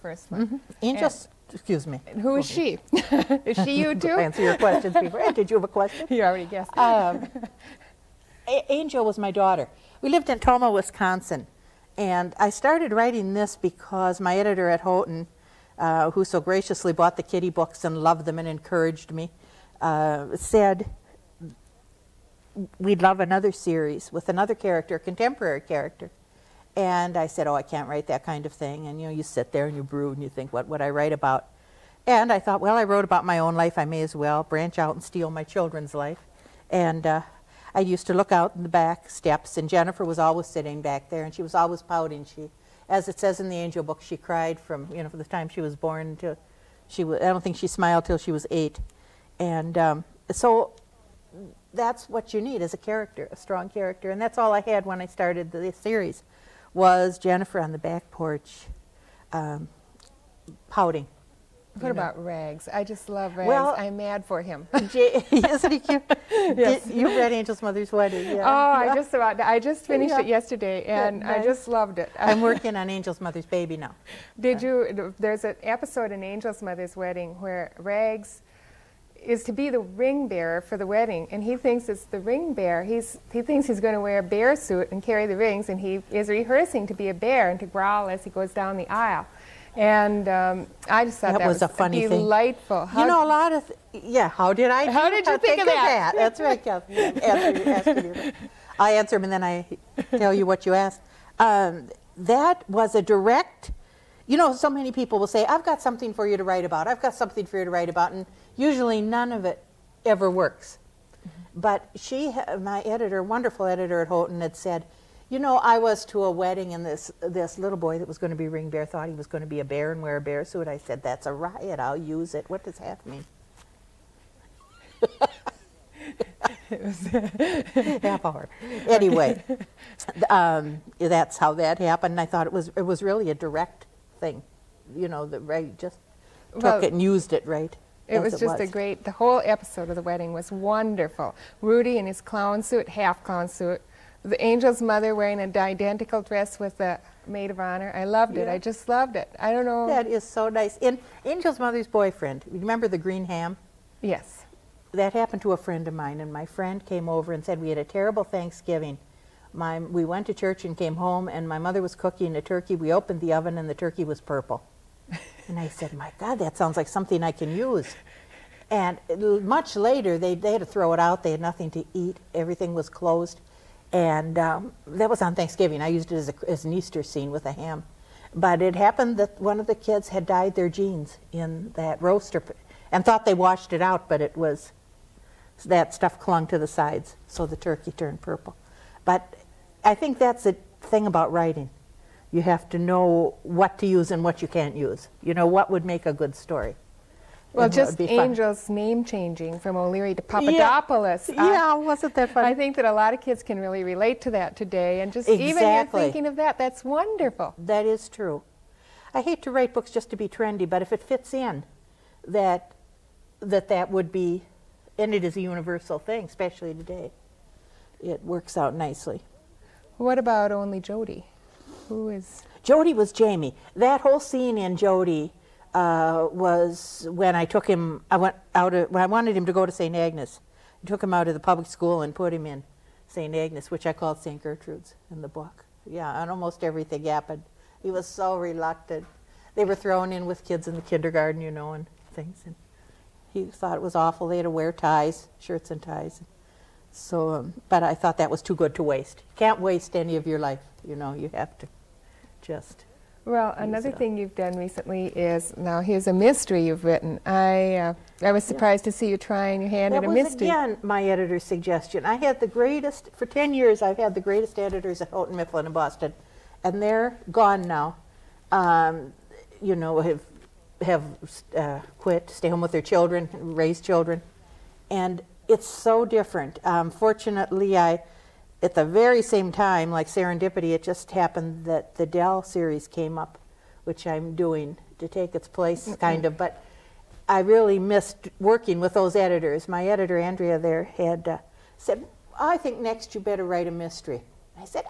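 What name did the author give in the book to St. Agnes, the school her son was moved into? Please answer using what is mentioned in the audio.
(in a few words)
St. Gertrude's.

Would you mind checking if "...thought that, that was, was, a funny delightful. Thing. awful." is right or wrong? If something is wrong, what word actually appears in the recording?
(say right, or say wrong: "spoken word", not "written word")
wrong: "delightful", not "awful".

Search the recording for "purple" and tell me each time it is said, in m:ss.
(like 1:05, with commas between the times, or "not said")
2:44, 3:08.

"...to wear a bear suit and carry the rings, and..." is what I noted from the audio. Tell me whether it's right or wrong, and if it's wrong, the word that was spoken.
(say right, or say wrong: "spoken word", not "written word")
right.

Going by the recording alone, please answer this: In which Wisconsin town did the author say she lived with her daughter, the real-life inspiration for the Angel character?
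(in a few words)
Tomah.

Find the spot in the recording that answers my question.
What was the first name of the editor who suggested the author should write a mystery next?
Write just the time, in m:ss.
4:50.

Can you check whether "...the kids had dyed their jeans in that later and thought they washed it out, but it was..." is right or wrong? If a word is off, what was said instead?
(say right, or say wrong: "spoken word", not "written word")
wrong: "roaster", not "later".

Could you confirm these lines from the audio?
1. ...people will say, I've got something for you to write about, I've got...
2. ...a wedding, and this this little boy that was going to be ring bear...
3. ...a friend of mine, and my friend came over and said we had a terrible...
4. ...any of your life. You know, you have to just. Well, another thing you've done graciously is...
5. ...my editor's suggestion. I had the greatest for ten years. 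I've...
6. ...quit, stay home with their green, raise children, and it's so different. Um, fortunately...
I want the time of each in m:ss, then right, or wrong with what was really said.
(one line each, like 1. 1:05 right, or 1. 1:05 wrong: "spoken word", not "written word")
1. 1:44 right
2. 1:56 right
3. 2:35 right
4. 4:09 wrong: "recently", not "graciously"
5. 4:20 right
6. 4:31 wrong: "children", not "green".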